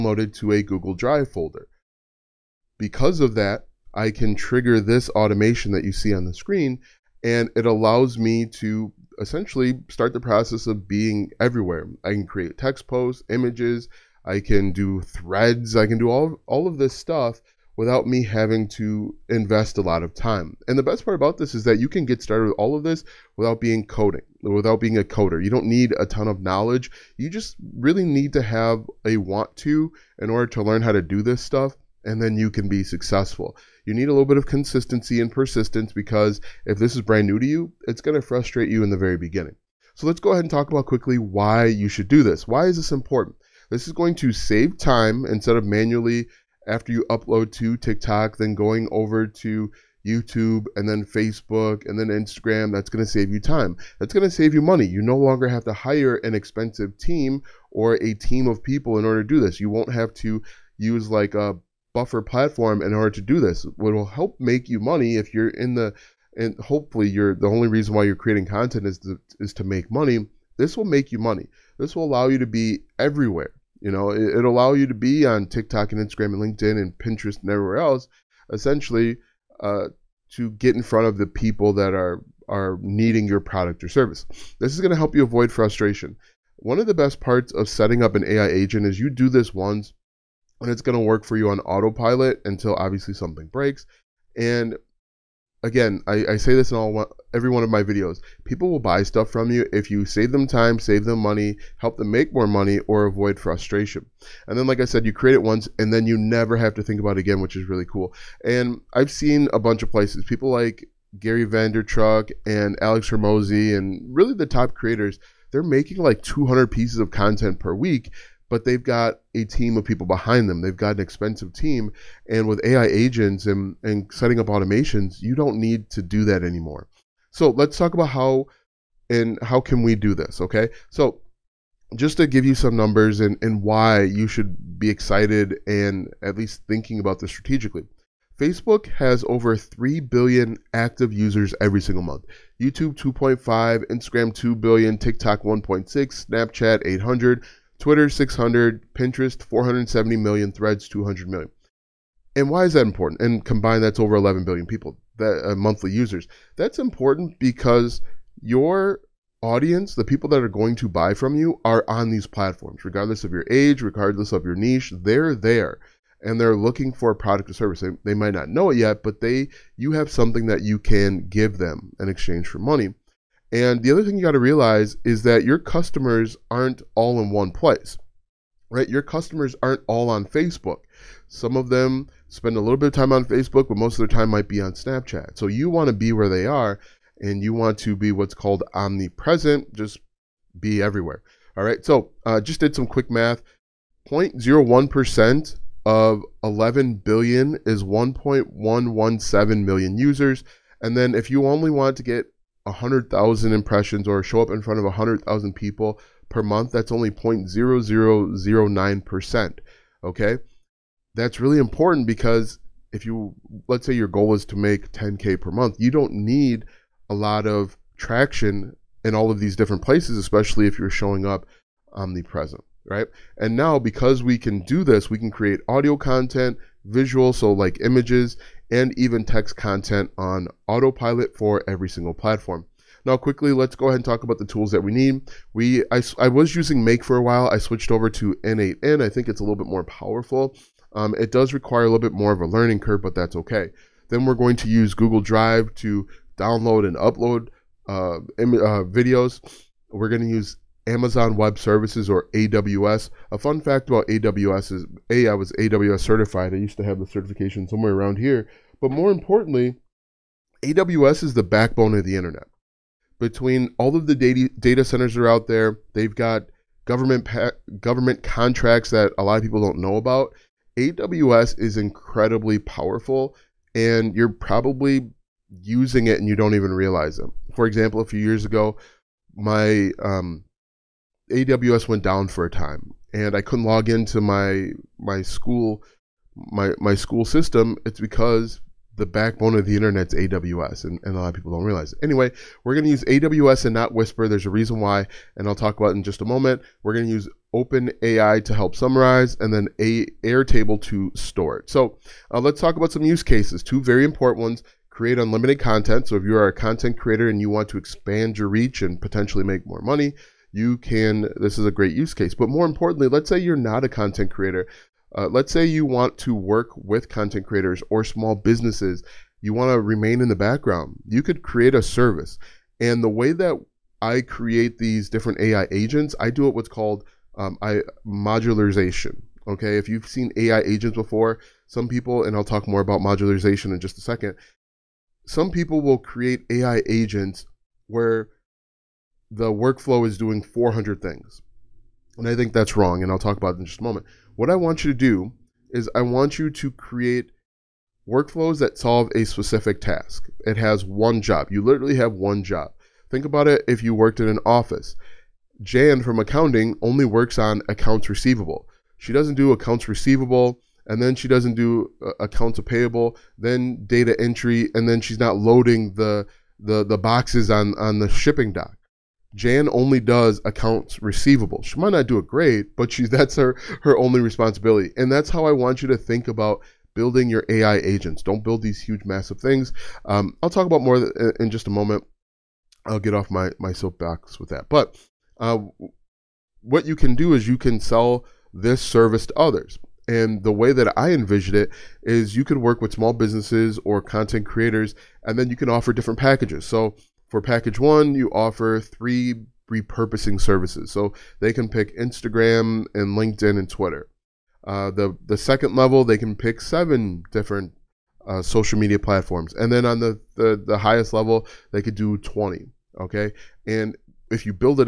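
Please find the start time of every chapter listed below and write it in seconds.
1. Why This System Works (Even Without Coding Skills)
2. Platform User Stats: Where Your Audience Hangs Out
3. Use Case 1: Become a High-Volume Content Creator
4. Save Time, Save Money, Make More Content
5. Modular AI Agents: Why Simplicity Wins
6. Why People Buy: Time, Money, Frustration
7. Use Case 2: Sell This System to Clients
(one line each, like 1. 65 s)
1. 11 s
2. 120 s
3. 305 s
4. 31 s
5. 395 s
6. 93 s
7. 328 s.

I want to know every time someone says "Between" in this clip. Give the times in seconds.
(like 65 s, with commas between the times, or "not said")
263 s.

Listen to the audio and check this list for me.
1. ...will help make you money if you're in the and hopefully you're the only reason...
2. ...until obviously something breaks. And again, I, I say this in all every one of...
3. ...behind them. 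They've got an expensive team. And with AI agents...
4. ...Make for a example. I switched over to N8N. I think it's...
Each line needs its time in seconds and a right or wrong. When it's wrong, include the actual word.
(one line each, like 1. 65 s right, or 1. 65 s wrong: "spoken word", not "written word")
1. 63 s right
2. 92 s right
3. 120 s right
4. 236 s wrong: "while", not "example".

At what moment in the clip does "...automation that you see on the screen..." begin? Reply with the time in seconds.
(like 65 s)
5 s.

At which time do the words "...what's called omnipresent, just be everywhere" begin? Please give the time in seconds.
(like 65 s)
188 s.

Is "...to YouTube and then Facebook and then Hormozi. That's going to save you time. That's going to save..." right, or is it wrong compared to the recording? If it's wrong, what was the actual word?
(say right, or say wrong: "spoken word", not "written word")
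wrong: "Instagram", not "Hormozi".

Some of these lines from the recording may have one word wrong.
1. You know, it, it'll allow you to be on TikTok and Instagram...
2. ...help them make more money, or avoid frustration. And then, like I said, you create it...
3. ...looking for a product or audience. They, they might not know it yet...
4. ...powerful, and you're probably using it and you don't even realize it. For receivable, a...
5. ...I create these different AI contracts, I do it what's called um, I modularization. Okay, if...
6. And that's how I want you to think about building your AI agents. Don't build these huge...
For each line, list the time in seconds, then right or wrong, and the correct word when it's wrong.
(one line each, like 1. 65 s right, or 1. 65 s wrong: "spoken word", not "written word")
1. 73 s right
2. 101 s right
3. 166 s wrong: "service", not "audience"
4. 272 s wrong: "example", not "receivable"
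5. 324 s wrong: "agents", not "contracts"
6. 374 s right.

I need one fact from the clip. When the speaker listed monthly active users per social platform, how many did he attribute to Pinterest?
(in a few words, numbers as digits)
470 million.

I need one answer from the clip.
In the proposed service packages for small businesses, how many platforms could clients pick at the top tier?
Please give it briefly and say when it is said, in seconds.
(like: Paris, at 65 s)
20, at 412 s.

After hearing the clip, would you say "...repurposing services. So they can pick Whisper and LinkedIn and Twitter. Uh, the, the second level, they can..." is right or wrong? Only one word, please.
wrong.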